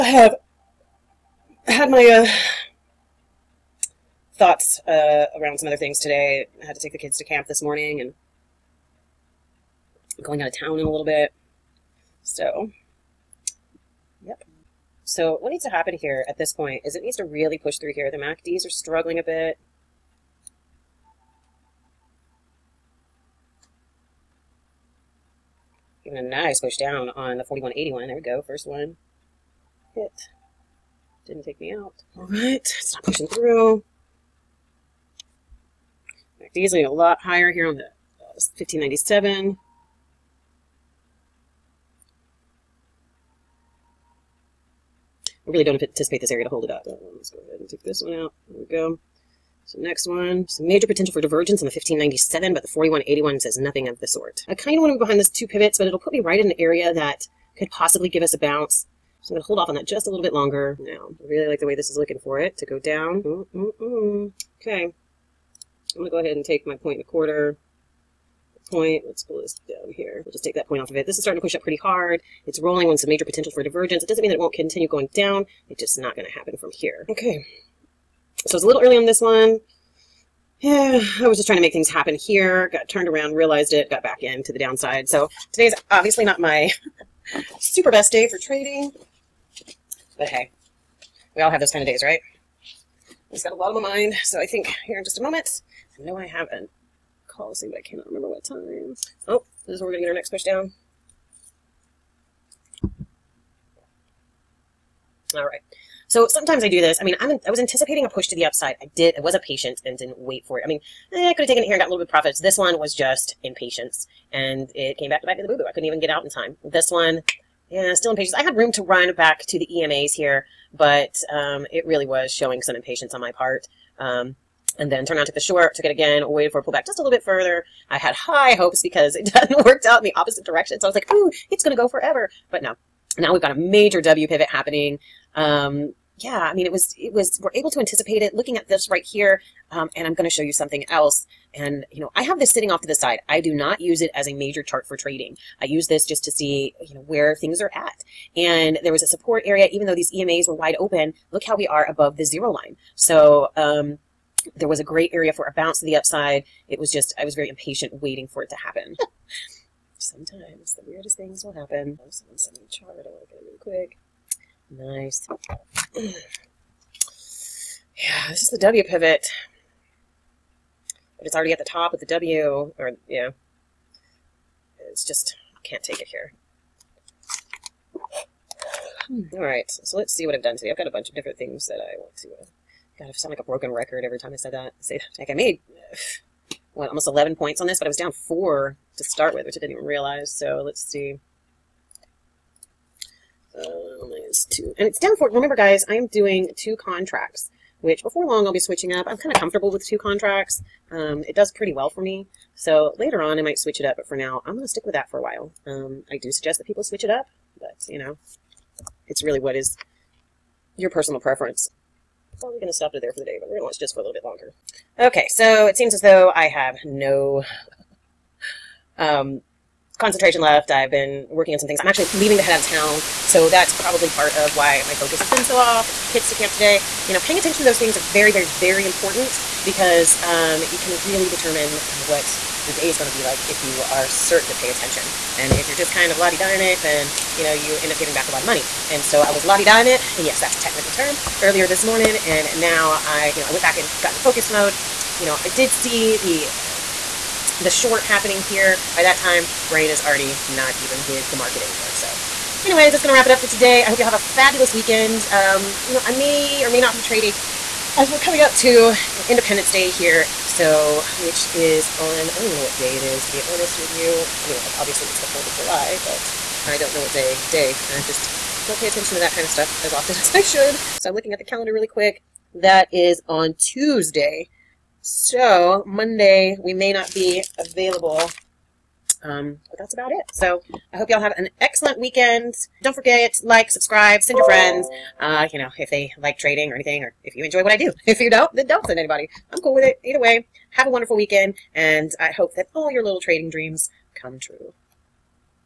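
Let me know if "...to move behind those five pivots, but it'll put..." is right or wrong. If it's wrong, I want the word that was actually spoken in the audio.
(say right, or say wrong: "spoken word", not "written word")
wrong: "two", not "five".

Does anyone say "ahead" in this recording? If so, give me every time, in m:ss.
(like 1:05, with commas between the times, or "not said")
0:47, 1:06.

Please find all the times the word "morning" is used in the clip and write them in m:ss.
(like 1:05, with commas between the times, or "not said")
0:07, 4:01.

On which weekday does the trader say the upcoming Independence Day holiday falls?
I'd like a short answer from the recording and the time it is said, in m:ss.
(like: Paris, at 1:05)
Tuesday, at 4:33.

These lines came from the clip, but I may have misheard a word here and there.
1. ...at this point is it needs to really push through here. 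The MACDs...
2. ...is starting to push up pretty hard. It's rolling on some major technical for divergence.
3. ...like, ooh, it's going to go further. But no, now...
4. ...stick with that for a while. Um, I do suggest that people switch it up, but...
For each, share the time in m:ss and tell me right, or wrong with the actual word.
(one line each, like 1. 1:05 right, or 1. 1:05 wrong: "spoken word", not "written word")
1. 0:16 right
2. 1:11 wrong: "potential", not "technical"
3. 2:10 wrong: "forever", not "further"
4. 3:24 right.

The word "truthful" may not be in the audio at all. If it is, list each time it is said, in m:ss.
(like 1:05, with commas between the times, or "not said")
not said.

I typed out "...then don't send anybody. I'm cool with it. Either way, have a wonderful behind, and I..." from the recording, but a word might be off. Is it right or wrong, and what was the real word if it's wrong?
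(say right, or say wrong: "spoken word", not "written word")
wrong: "weekend", not "behind".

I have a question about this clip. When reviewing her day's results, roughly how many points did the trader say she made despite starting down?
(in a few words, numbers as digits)
almost 11.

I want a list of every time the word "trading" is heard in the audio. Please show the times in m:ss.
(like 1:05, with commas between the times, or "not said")
1:28, 2:24, 4:17, 4:46, 4:53.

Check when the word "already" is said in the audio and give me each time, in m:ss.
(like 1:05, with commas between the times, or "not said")
2:51, 4:09.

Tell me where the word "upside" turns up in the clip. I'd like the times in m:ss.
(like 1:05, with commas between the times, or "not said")
1:48, 2:35.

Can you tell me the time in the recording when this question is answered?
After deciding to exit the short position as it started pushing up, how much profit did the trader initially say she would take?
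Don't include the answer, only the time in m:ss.
1:06.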